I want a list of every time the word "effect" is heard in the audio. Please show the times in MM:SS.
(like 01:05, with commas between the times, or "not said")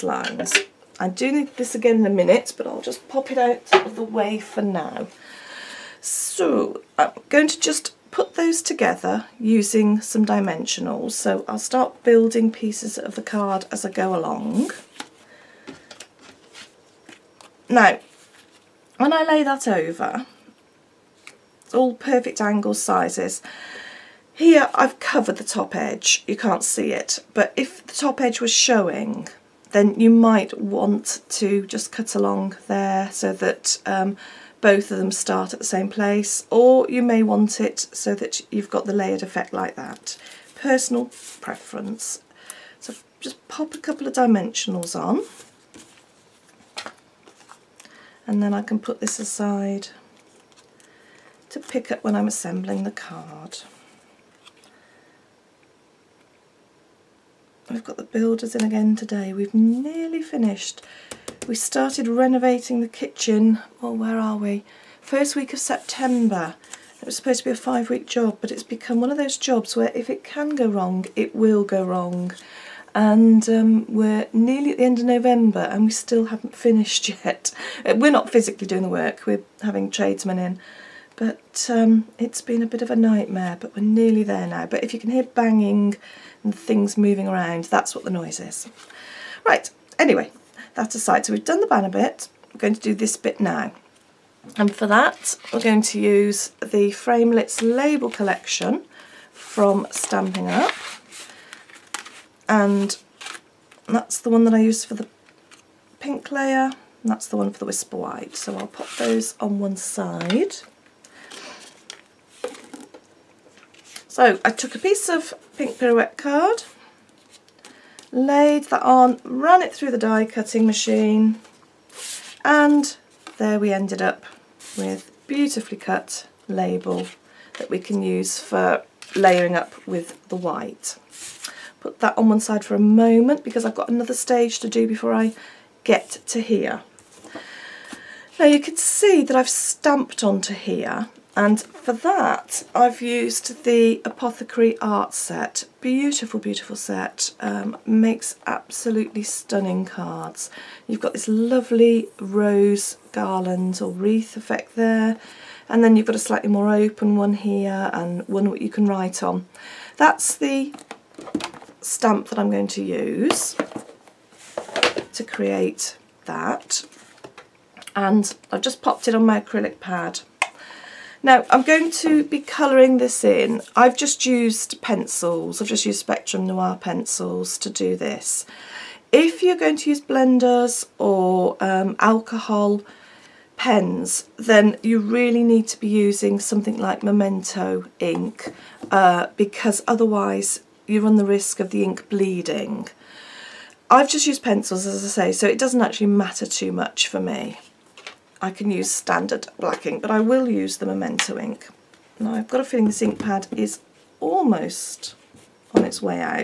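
00:39, 02:34.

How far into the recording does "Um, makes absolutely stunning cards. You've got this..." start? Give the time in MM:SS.
02:27.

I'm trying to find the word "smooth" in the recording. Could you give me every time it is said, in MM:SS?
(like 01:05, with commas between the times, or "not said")
not said.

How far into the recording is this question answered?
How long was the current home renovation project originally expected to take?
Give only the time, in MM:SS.
01:07.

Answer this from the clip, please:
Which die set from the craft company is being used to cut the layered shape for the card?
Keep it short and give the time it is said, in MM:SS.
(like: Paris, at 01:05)
Framelits label collection, at 01:36.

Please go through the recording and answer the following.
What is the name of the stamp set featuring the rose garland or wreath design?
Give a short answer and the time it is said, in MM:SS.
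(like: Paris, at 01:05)
Apothecary Art, at 02:24.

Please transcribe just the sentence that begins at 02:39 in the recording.
That's the stamp that I'm going to use to create that.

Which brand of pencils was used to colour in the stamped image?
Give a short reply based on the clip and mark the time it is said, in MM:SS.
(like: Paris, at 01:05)
Spectrum Noir, at 02:55.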